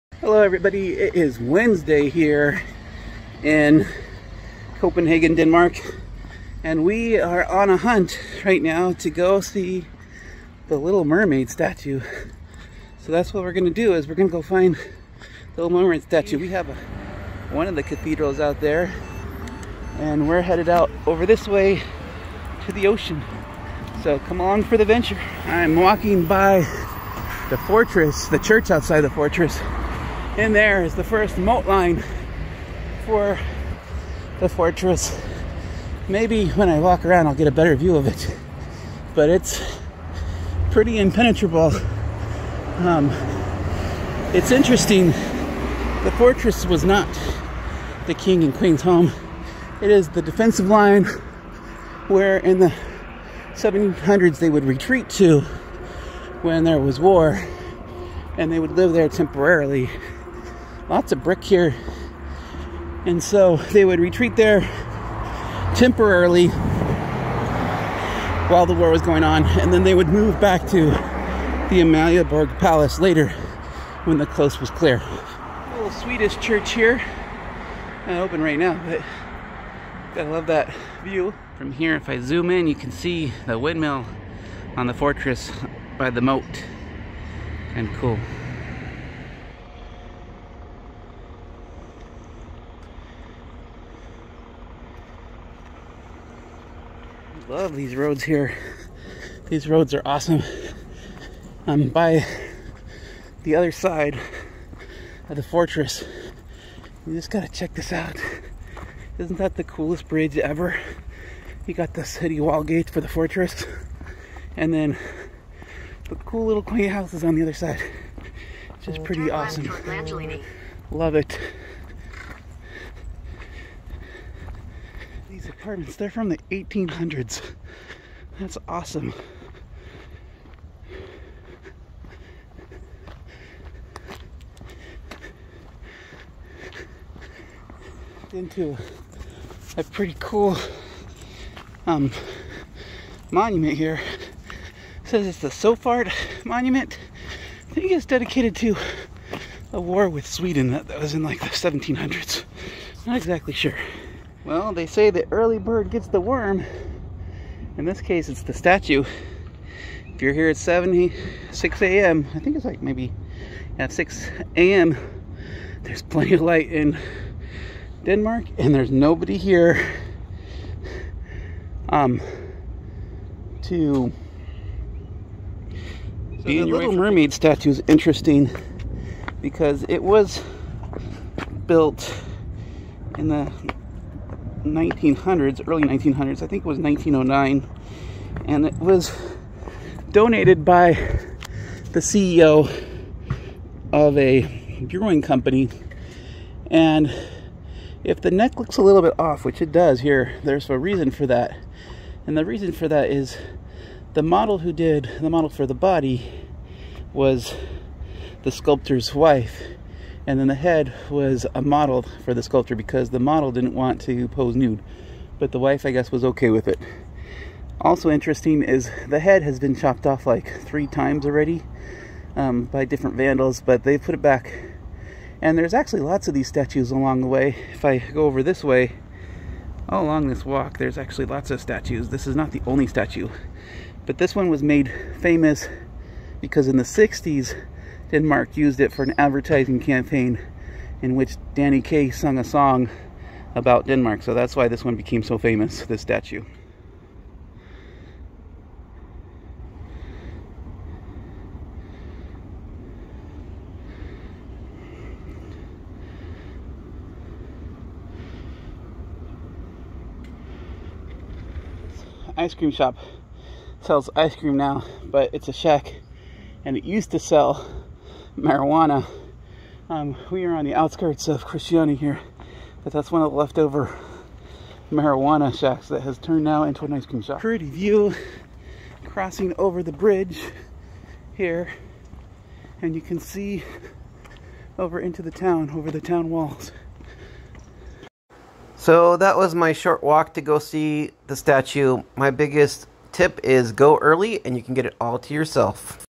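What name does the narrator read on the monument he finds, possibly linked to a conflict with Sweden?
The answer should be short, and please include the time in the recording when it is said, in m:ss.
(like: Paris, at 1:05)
Sofart Monument, at 2:25.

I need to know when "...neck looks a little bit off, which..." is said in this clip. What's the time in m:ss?
3:18.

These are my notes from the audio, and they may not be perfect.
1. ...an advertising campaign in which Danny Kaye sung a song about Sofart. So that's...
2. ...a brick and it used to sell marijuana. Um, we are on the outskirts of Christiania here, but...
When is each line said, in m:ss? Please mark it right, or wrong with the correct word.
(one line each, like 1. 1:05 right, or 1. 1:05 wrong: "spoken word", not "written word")
1. 3:59 wrong: "Denmark", not "Sofart"
2. 4:25 wrong: "shack", not "brick".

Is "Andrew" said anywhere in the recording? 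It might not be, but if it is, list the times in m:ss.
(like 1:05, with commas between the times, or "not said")
not said.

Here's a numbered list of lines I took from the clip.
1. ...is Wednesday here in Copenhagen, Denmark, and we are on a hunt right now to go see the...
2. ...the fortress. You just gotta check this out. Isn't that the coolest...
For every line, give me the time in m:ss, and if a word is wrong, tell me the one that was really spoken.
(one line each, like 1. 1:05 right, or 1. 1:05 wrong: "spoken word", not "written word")
1. 0:01 right
2. 1:45 right.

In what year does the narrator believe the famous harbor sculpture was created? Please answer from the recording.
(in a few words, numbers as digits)
1909.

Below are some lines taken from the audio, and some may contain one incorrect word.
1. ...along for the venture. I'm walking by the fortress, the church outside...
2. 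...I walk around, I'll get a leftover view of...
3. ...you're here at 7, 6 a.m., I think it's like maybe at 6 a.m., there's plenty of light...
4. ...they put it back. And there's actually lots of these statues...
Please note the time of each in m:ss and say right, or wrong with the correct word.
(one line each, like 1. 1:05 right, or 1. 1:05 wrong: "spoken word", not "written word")
1. 0:24 right
2. 0:36 wrong: "better", not "leftover"
3. 2:40 right
4. 3:43 right.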